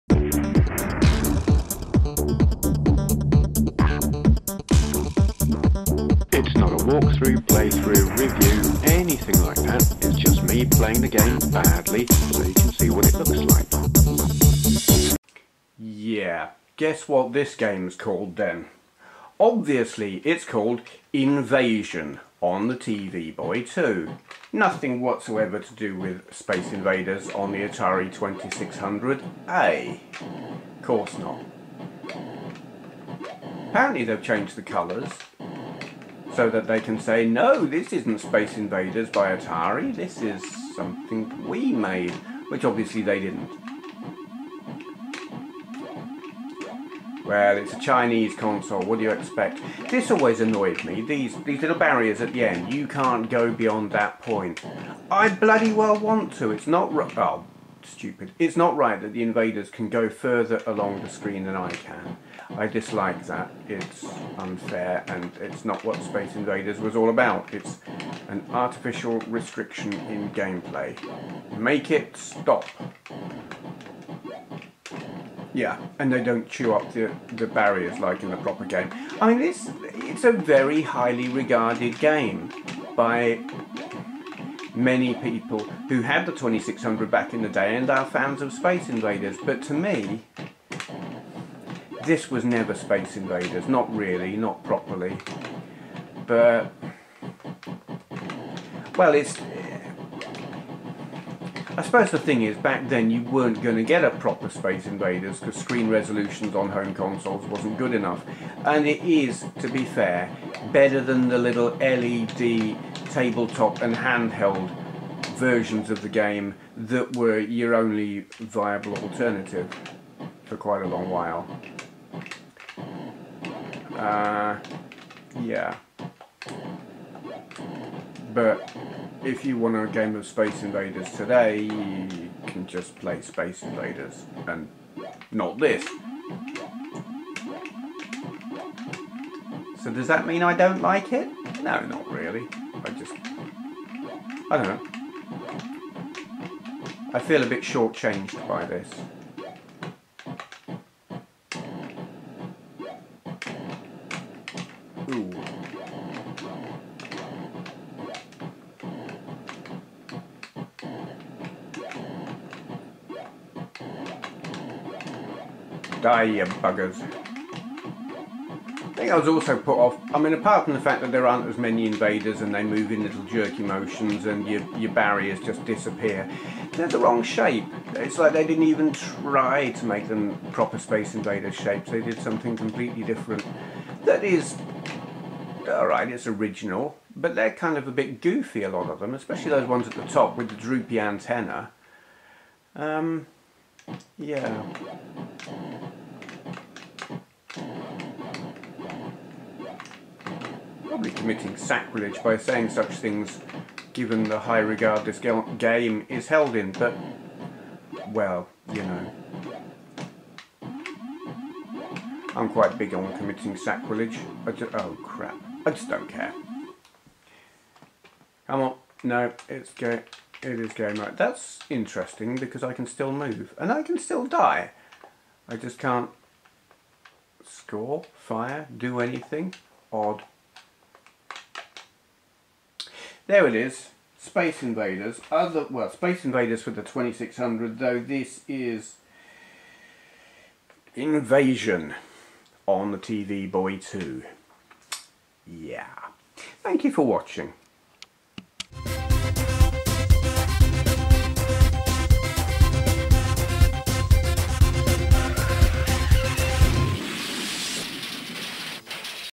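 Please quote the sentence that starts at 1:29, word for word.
But to me, this was never Space Invaders.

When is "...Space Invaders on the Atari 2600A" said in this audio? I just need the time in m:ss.
0:26.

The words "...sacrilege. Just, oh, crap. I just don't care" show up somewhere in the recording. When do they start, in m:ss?
3:33.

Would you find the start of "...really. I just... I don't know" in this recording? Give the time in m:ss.
2:22.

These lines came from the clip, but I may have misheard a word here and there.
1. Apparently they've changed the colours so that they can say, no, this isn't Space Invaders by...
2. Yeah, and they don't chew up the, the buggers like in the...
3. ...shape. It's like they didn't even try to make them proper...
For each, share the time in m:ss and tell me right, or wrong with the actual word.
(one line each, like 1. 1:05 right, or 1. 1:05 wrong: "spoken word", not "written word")
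1. 0:33 right
2. 1:15 wrong: "barriers", not "buggers"
3. 2:57 right.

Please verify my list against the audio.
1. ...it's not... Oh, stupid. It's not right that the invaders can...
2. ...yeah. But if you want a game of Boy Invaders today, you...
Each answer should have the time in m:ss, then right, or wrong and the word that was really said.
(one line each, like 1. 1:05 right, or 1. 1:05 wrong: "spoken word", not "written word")
1. 0:56 right
2. 2:05 wrong: "Space", not "Boy".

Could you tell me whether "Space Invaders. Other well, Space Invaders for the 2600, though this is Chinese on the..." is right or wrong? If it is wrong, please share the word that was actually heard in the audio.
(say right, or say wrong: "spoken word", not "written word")
wrong: "Invasion", not "Chinese".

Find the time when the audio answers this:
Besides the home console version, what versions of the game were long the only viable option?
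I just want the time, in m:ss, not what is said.
1:51.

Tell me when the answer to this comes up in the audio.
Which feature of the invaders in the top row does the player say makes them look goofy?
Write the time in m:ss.
3:10.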